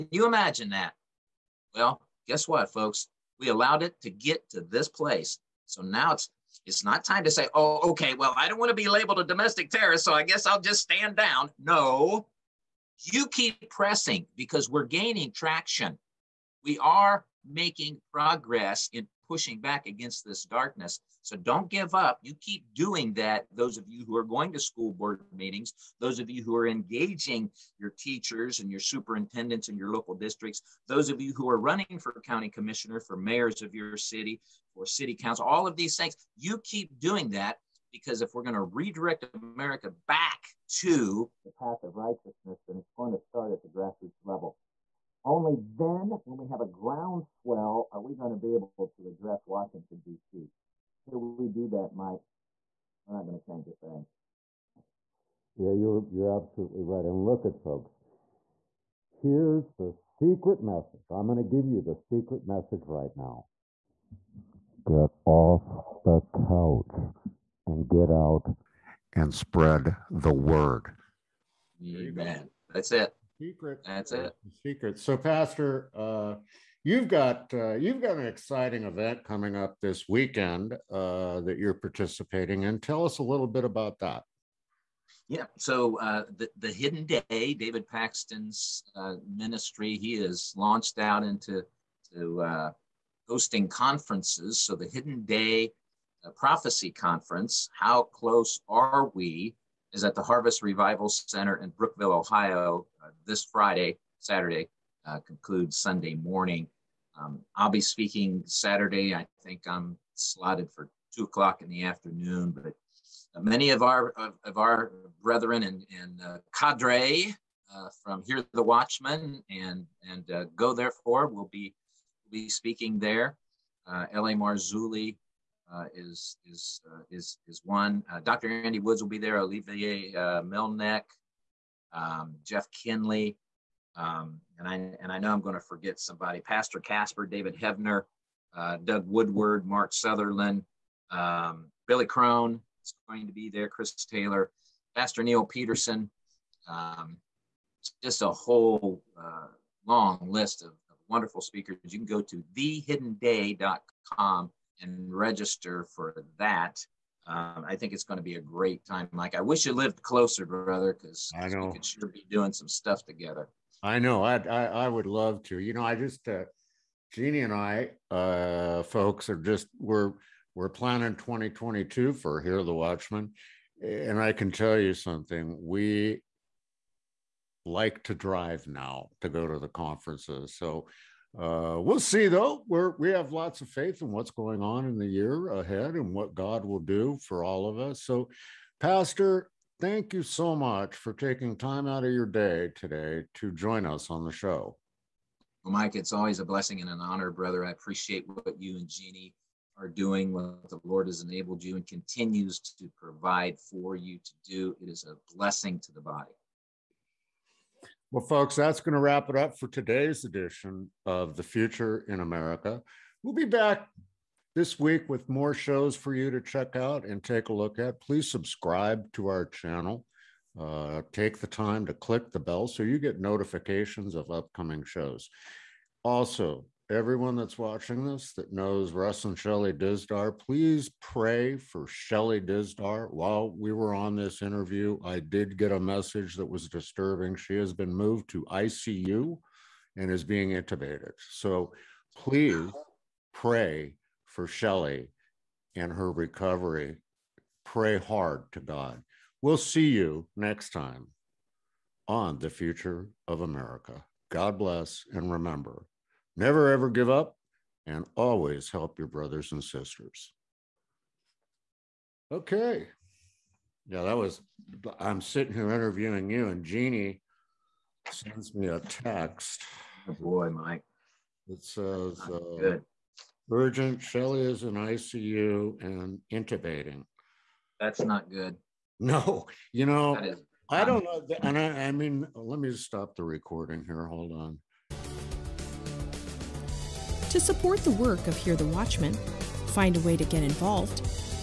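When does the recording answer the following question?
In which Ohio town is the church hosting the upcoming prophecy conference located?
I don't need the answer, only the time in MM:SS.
01:41.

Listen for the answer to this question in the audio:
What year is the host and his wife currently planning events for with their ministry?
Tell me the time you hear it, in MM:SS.
02:51.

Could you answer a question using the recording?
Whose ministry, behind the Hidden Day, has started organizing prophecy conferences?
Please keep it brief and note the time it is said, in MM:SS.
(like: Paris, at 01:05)
David Paxton, at 01:27.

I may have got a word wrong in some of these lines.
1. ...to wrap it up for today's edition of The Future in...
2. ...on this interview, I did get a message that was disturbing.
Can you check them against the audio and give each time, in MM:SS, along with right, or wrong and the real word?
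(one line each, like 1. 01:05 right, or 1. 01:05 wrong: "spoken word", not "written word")
1. 03:28 right
2. 03:53 right.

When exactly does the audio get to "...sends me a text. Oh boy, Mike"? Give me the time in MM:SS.
04:28.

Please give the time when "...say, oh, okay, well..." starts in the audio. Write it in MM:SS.
00:07.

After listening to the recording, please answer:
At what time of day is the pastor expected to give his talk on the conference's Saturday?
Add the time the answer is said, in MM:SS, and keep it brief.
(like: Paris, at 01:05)
2 o'clock, at 01:51.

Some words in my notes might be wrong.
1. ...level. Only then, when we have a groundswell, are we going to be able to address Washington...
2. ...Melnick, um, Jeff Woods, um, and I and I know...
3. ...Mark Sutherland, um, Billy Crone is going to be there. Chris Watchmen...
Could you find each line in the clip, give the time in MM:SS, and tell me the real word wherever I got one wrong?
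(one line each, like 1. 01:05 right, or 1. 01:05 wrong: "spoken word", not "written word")
1. 00:44 right
2. 02:10 wrong: "Kinley", not "Woods"
3. 02:19 wrong: "Taylor", not "Watchmen".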